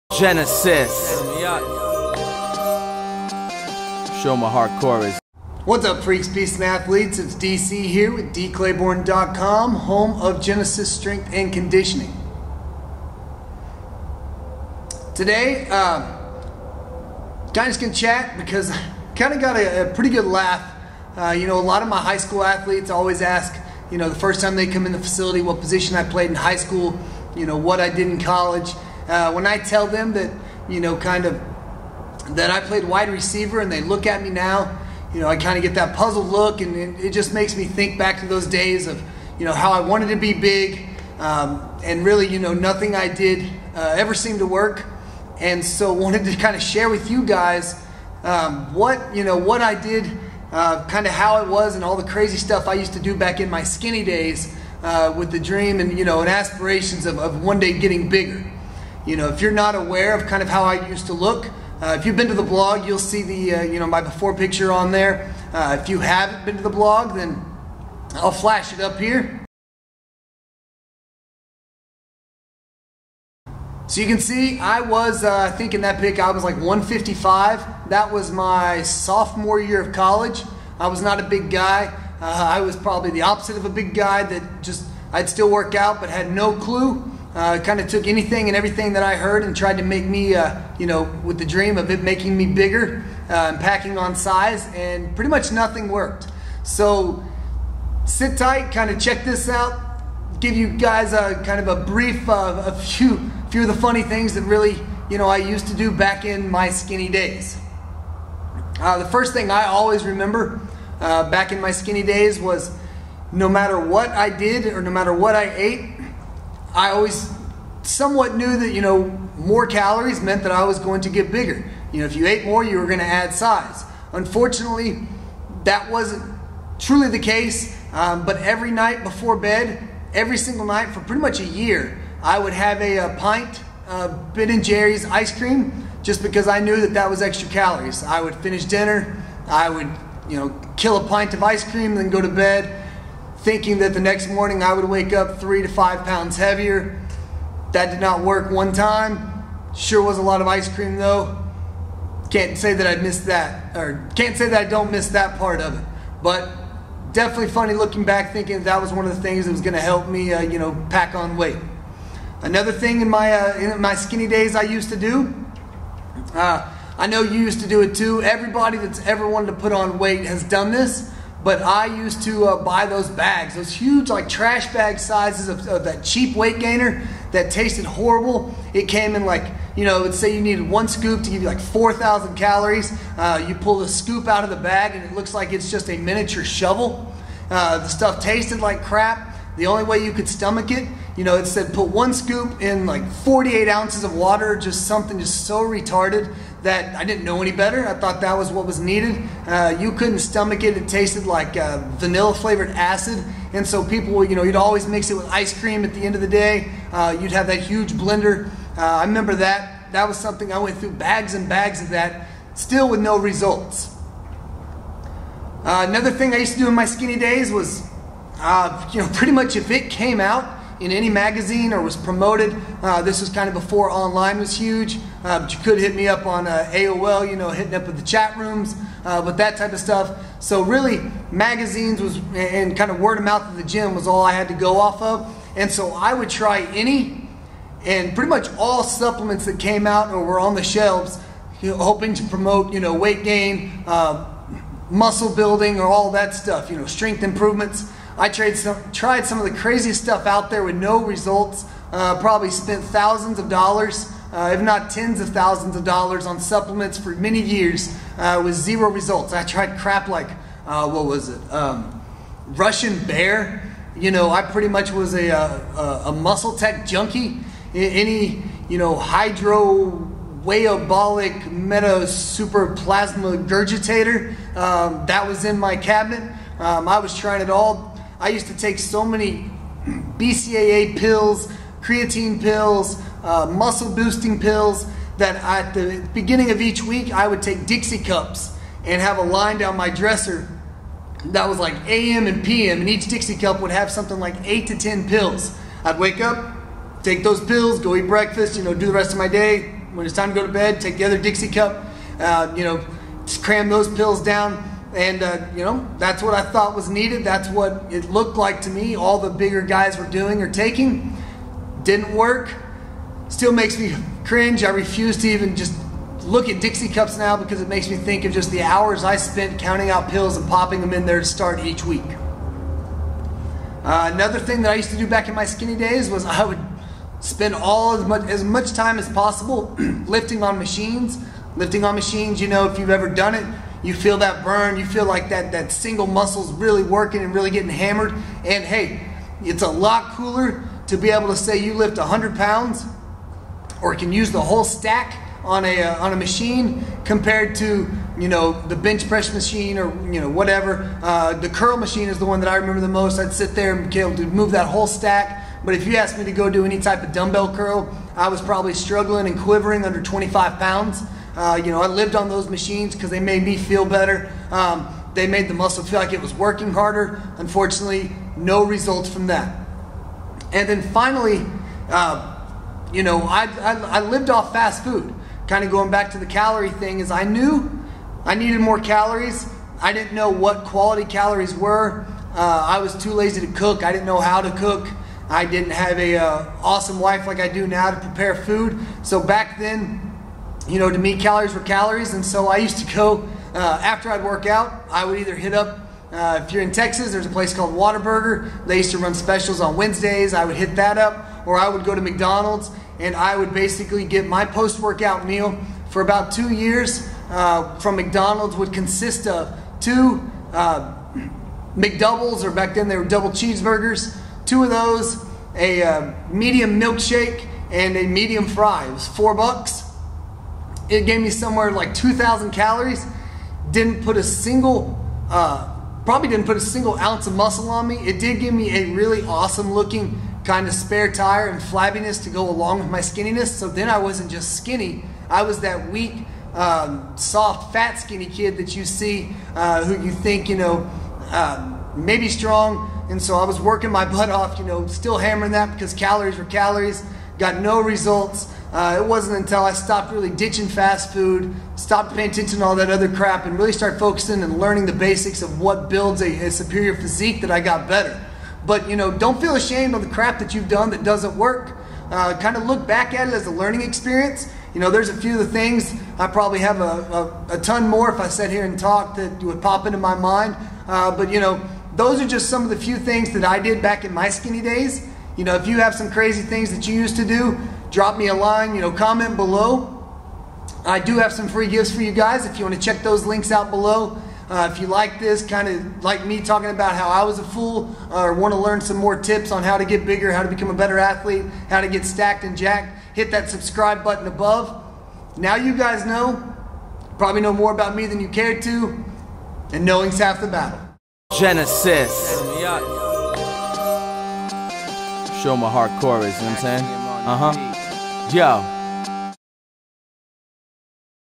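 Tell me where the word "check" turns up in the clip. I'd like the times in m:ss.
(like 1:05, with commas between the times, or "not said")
1:38, 8:02.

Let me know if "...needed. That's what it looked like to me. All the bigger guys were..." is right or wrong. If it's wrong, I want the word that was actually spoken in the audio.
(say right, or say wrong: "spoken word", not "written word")
right.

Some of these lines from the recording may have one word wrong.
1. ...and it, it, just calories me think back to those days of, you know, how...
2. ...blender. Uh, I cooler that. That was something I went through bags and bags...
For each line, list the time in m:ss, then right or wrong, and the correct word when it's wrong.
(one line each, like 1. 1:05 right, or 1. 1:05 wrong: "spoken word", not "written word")
1. 0:36 wrong: "makes", not "calories"
2. 3:27 wrong: "remember", not "cooler".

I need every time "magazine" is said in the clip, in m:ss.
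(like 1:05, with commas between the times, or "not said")
3:41, 3:51.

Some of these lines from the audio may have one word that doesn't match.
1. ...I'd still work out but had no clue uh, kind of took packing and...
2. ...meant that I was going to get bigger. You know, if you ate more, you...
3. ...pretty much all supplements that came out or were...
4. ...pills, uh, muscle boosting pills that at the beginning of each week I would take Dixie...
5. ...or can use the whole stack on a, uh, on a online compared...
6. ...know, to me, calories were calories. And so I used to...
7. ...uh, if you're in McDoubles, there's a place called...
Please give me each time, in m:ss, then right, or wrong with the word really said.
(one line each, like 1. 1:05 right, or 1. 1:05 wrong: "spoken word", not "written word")
1. 1:25 wrong: "anything", not "packing"
2. 2:00 right
3. 3:58 right
4. 4:42 right
5. 5:43 wrong: "machine", not "online"
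6. 6:30 right
7. 6:36 wrong: "Texas", not "McDoubles".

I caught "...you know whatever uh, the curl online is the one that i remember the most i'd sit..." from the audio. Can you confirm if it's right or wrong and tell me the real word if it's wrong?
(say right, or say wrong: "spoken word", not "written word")
wrong: "machine", not "online".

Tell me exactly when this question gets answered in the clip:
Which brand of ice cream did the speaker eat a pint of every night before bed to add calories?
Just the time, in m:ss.
2:14.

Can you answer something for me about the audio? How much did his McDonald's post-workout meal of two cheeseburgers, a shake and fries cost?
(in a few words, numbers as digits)
4 dollars.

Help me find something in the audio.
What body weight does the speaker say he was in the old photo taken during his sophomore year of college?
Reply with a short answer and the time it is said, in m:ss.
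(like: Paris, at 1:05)
155, at 1:16.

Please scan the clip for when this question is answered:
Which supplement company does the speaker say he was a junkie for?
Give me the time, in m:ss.
4:26.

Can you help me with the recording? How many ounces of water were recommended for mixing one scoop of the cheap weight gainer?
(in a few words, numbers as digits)
48.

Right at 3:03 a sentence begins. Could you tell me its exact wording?
Uh, you pull the scoop out of the bag and it looks like it's just a miniature shovel.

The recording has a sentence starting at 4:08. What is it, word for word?
I tried some, tried some of the craziest stuff out there with no results.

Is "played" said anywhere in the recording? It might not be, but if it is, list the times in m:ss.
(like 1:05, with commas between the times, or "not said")
0:26, 0:32.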